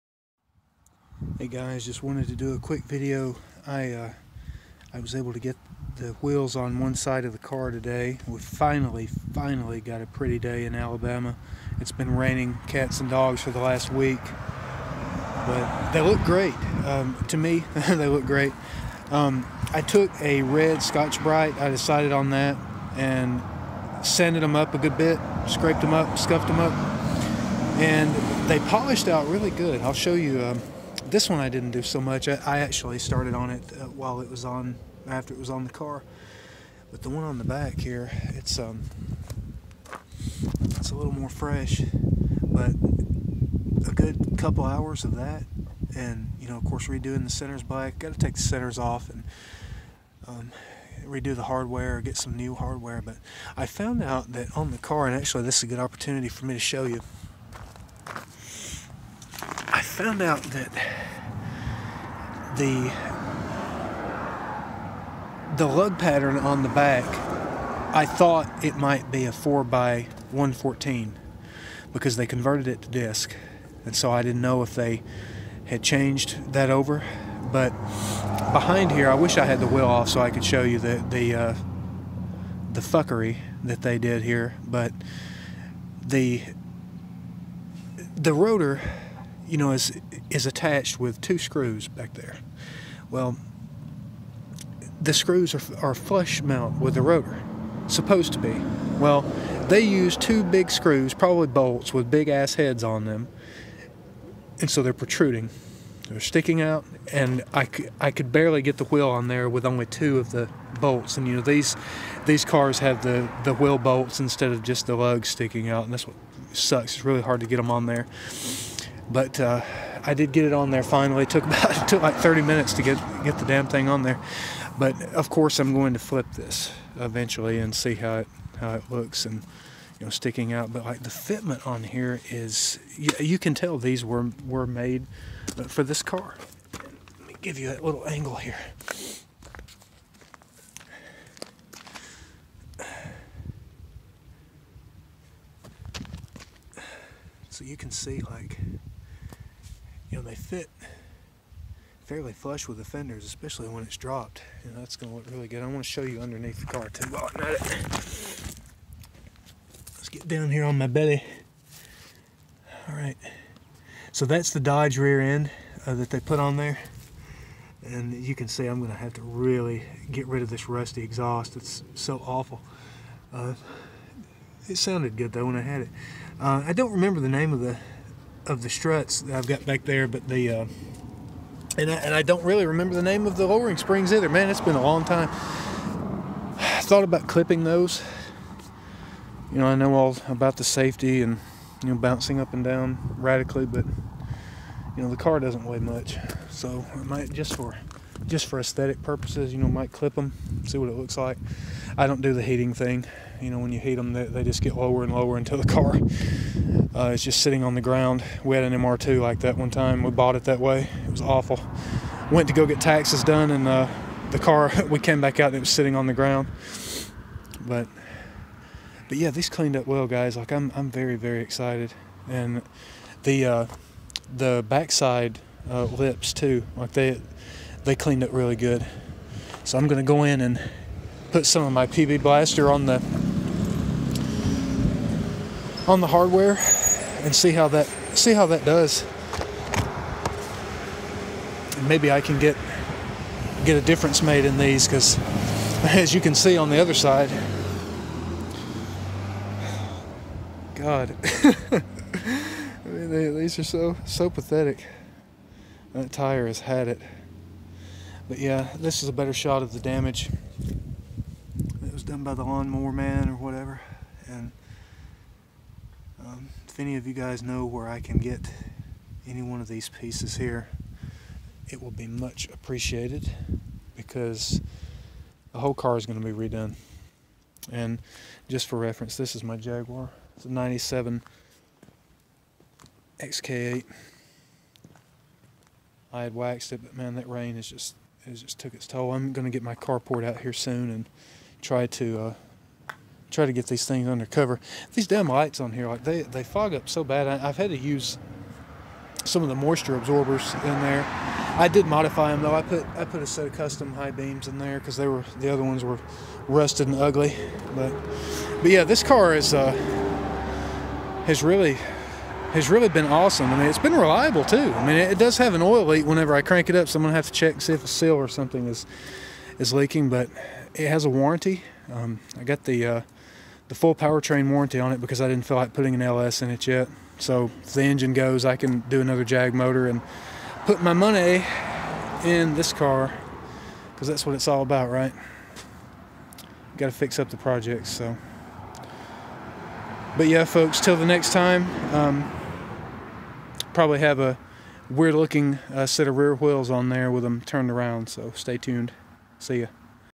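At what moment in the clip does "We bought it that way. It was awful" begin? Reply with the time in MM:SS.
03:30.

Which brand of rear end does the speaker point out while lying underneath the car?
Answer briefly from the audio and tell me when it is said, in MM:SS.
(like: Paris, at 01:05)
Dodge, at 02:44.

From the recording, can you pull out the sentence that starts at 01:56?
It's really hard to get them on there but uh, I did get it on there finally.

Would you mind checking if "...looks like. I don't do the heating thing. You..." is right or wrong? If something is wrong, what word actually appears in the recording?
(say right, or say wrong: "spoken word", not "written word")
right.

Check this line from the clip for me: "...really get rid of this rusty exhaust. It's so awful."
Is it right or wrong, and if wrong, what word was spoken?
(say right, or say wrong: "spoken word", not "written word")
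right.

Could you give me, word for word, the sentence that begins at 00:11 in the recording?
It's been raining cats and dogs for the last week, but they look great.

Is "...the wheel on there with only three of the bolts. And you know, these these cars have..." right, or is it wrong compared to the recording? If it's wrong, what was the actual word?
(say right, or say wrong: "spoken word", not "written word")
wrong: "two", not "three".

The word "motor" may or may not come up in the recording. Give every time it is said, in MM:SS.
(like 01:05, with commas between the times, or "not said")
05:29.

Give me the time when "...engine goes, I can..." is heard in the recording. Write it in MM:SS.
05:27.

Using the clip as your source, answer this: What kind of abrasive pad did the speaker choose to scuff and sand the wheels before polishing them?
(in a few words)
Red Scotch-Brite.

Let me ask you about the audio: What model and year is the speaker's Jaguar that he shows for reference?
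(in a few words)
97 XK8.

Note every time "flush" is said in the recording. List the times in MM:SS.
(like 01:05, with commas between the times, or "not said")
01:35, 02:32.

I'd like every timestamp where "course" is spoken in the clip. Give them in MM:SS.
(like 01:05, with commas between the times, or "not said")
00:46, 02:05.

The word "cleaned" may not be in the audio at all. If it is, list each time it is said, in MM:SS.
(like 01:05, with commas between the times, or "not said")
03:39, 03:47.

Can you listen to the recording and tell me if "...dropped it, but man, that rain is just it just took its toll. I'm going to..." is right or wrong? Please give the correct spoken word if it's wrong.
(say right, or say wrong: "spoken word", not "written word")
wrong: "waxed", not "dropped".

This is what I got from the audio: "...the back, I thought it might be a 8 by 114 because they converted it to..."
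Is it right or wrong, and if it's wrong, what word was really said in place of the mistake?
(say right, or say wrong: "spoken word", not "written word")
wrong: "4", not "8".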